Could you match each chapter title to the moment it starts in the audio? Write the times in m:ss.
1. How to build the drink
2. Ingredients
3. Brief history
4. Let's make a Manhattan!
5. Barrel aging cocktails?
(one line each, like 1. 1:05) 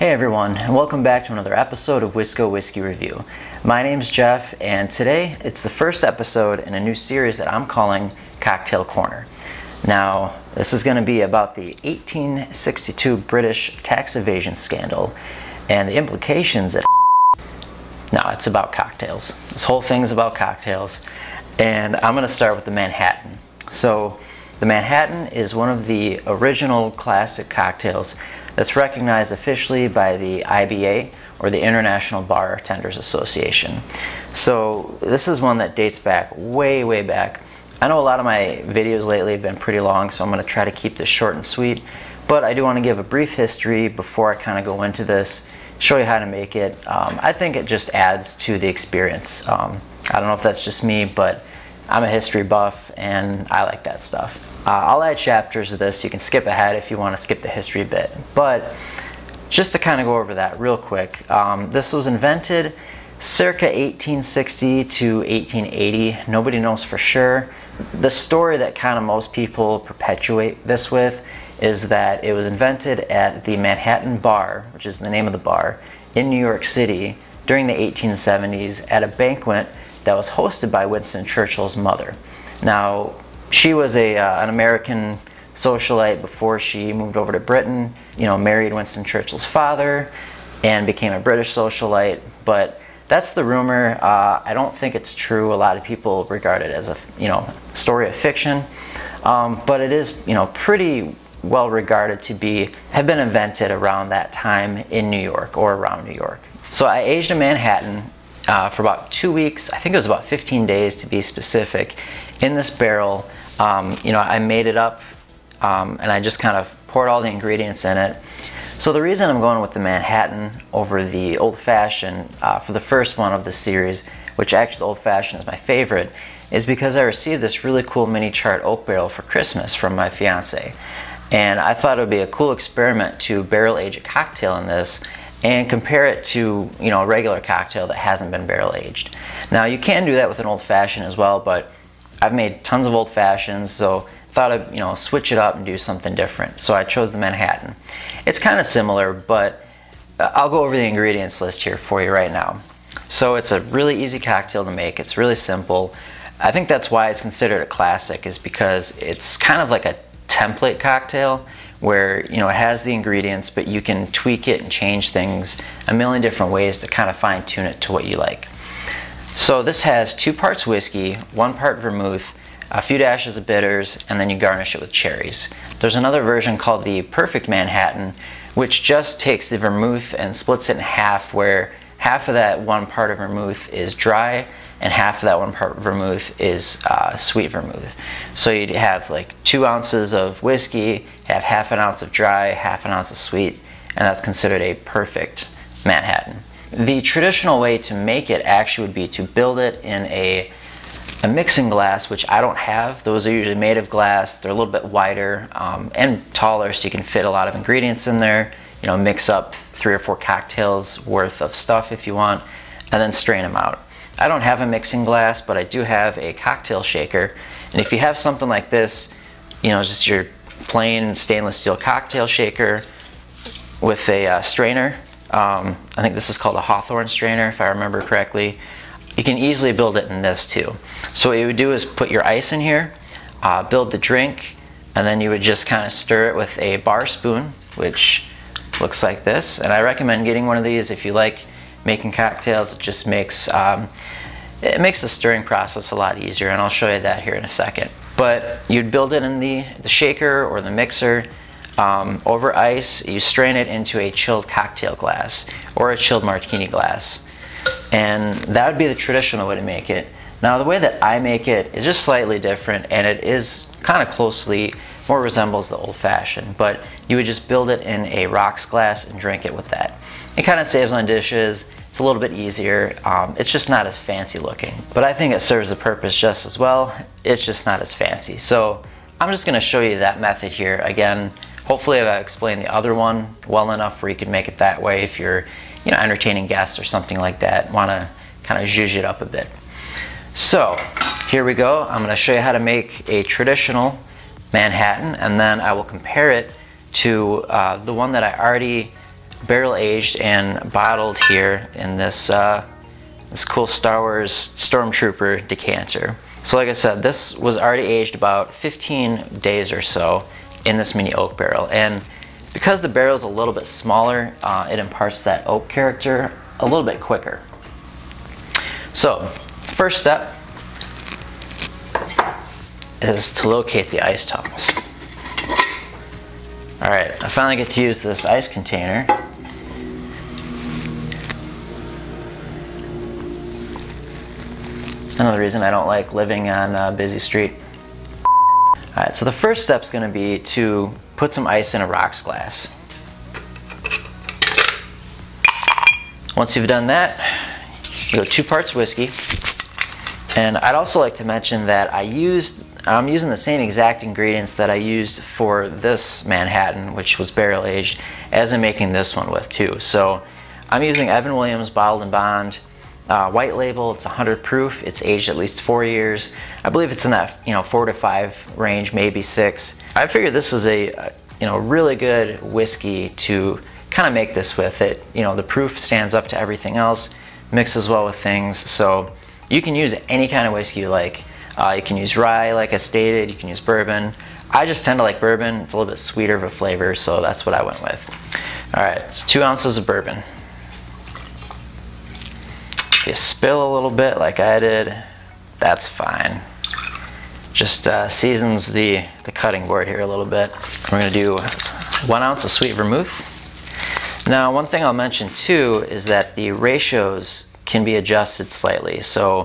1. 3:16
2. 2:29
3. 1:00
4. 4:49
5. 1:46.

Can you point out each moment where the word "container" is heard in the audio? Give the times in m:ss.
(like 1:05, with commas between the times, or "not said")
5:28.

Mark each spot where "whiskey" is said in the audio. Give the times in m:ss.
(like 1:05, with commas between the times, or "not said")
0:02, 2:50, 3:10, 5:48, 6:12, 6:20.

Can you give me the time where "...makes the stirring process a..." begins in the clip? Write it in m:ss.
4:04.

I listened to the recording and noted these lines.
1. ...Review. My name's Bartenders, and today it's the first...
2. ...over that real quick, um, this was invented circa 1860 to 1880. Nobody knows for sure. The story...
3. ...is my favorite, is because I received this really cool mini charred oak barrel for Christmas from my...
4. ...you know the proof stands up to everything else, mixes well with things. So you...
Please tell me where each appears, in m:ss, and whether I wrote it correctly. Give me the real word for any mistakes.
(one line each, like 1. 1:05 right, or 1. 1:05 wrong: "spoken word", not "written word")
1. 0:02 wrong: "Jeff", not "Bartenders"
2. 1:00 right
3. 2:05 right
4. 6:15 right.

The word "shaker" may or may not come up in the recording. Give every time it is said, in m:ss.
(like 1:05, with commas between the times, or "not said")
3:36, 3:42, 4:09.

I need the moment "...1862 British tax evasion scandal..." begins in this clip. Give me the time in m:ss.
0:11.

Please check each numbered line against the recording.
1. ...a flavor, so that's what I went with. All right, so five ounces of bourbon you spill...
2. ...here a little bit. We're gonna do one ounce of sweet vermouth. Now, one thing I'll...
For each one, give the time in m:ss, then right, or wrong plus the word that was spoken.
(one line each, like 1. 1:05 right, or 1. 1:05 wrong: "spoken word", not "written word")
1. 6:26 wrong: "two", not "five"
2. 6:39 right.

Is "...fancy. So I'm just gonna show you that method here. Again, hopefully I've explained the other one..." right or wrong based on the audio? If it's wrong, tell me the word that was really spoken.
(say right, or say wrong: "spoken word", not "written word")
right.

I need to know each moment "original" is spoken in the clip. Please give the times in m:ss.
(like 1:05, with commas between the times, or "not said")
0:26.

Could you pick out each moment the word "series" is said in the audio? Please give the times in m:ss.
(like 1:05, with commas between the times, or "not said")
0:06, 2:03.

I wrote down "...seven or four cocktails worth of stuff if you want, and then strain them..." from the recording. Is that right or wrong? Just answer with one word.
wrong.